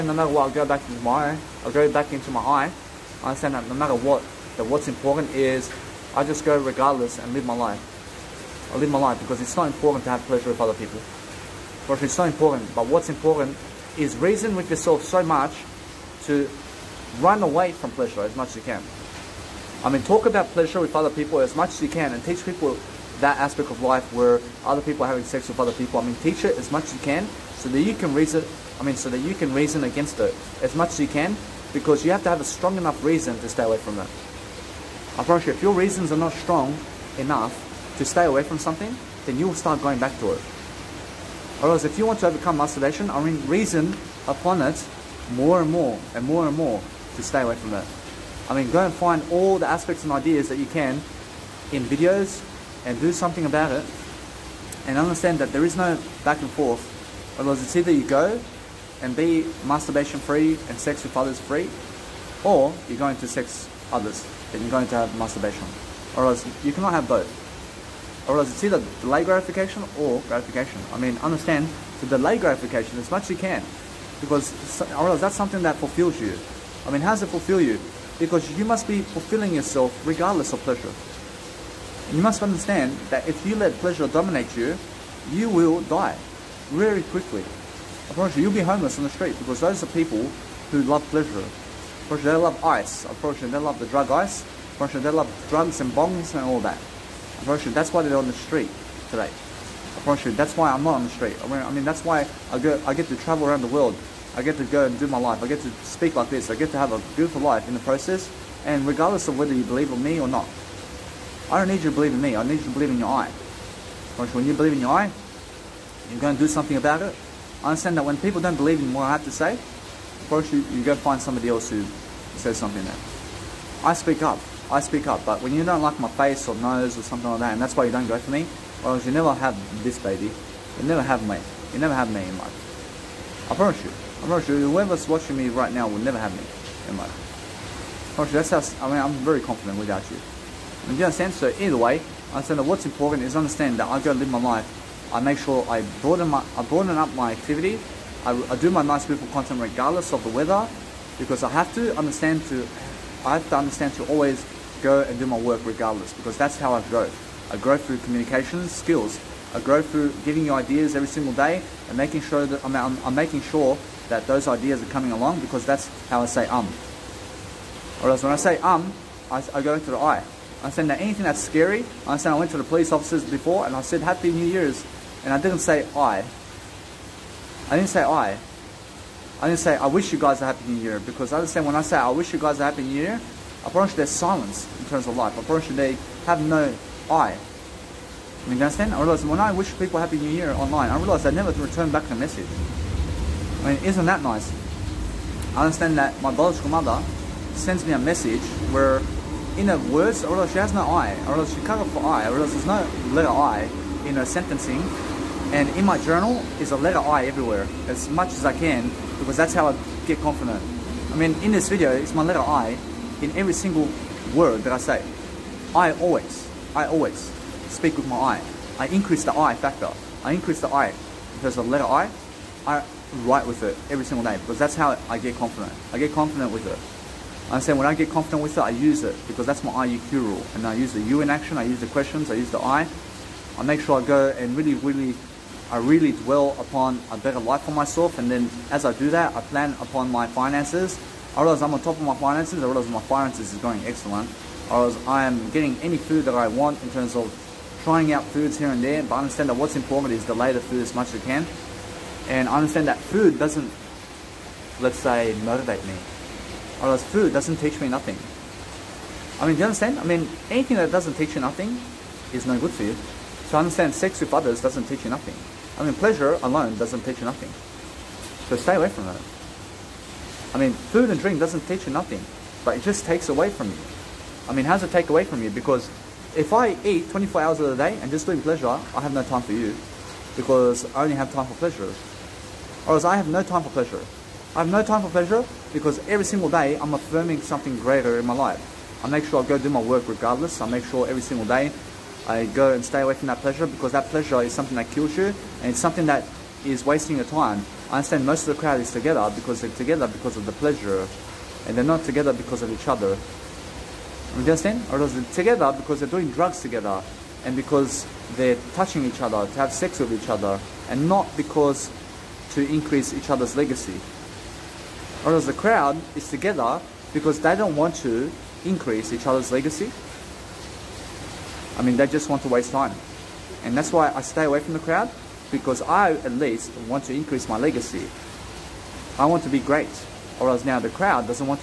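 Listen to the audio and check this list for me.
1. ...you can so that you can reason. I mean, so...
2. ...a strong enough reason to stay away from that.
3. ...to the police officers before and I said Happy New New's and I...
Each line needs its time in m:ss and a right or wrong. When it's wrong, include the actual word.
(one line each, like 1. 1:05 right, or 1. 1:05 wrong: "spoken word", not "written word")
1. 0:26 right
2. 0:32 right
3. 2:52 wrong: "Year", not "New".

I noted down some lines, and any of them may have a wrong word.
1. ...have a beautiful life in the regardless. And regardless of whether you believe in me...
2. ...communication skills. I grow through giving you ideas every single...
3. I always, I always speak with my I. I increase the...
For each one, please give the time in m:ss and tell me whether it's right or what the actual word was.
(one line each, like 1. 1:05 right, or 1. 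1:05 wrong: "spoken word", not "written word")
1. 1:46 wrong: "process", not "regardless"
2. 2:37 right
3. 3:35 right.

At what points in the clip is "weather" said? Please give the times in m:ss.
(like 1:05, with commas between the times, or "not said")
2:30.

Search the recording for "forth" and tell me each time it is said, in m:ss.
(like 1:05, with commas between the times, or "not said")
0:56.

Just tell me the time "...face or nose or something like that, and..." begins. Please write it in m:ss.
2:06.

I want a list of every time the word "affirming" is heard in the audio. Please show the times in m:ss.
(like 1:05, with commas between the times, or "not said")
4:46.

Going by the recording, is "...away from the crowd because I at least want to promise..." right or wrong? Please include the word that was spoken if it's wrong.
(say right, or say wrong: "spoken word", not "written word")
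wrong: "increase", not "promise".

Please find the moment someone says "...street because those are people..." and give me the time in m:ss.
1:29.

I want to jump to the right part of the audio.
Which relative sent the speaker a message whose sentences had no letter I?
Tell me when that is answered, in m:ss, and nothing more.
3:16.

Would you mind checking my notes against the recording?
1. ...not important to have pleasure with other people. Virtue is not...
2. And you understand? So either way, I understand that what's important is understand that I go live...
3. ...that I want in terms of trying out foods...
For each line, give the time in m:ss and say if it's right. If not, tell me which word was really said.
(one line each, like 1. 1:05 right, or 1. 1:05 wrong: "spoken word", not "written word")
1. 0:09 right
2. 2:20 right
3. 4:06 right.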